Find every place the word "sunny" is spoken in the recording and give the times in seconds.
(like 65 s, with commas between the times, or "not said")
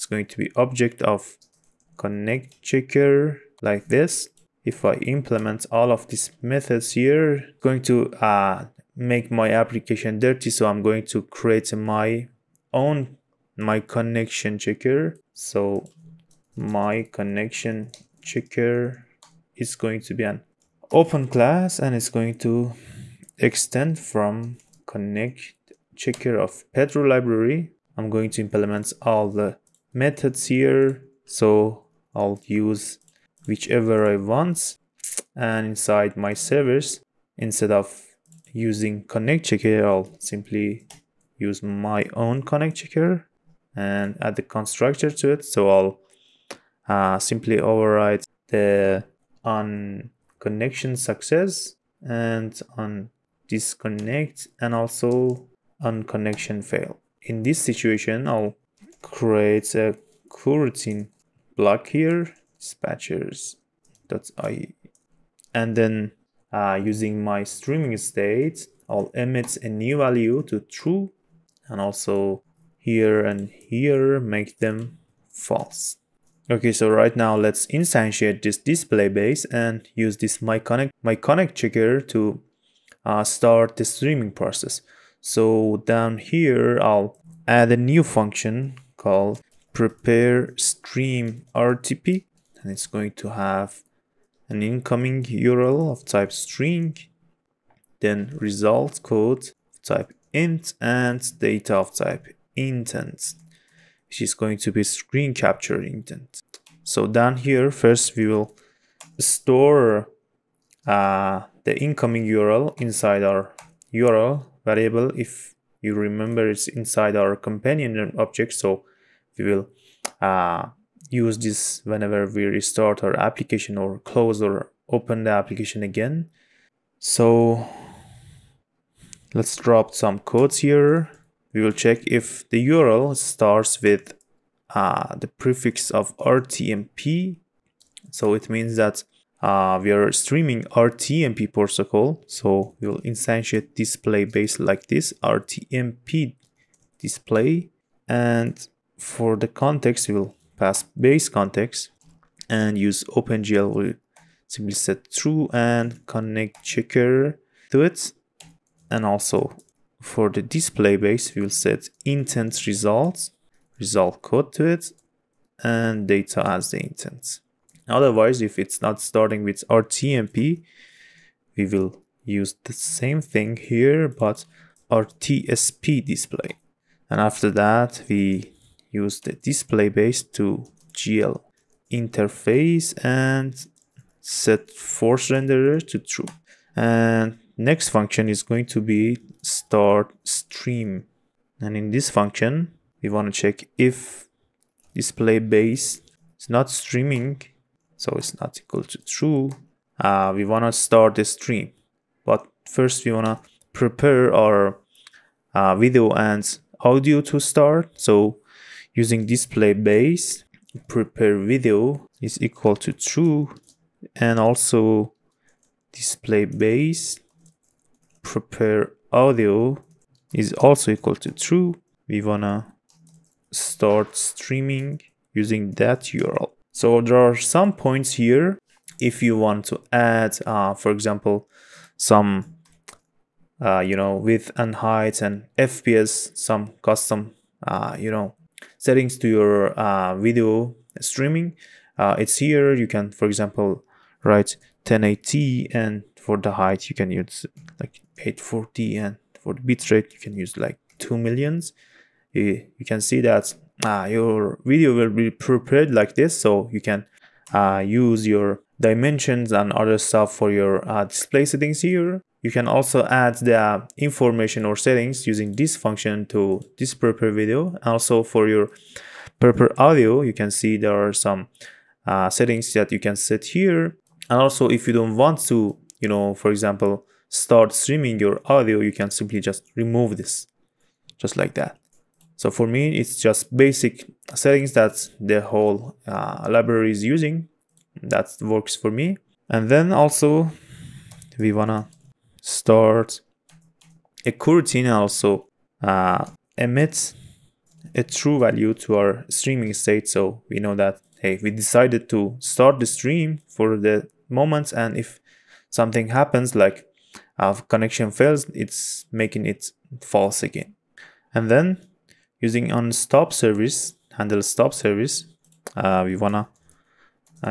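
not said.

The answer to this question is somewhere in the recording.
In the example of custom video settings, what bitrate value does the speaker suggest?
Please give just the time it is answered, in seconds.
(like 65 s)
250 s.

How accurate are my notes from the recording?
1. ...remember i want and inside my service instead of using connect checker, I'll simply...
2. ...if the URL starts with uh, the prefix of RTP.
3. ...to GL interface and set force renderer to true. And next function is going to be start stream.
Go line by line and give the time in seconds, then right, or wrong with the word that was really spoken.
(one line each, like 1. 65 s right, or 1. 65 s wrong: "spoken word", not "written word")
1. 33 s wrong: "whichever", not "remember"
2. 132 s wrong: "RTMP", not "RTP"
3. 180 s right.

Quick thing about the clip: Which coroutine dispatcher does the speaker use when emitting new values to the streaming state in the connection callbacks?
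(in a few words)
Dispatchers.IO.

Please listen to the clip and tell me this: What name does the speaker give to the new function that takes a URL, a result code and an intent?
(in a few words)
prepare stream RTP.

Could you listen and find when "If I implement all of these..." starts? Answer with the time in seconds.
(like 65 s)
4 s.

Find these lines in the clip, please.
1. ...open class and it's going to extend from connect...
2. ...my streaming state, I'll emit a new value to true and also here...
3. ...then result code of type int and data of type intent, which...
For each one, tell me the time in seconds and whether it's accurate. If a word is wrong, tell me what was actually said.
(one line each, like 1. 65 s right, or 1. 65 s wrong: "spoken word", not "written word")
1. 20 s right
2. 67 s right
3. 97 s right.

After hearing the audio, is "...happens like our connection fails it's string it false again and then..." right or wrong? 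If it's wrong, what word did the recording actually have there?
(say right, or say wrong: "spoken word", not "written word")
wrong: "making", not "string".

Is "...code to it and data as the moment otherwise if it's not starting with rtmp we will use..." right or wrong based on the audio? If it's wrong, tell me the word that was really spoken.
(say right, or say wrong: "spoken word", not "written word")
wrong: "intent", not "moment".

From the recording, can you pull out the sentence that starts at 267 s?
Also for your proper audio, you can see there are some uh, settings that you can set here.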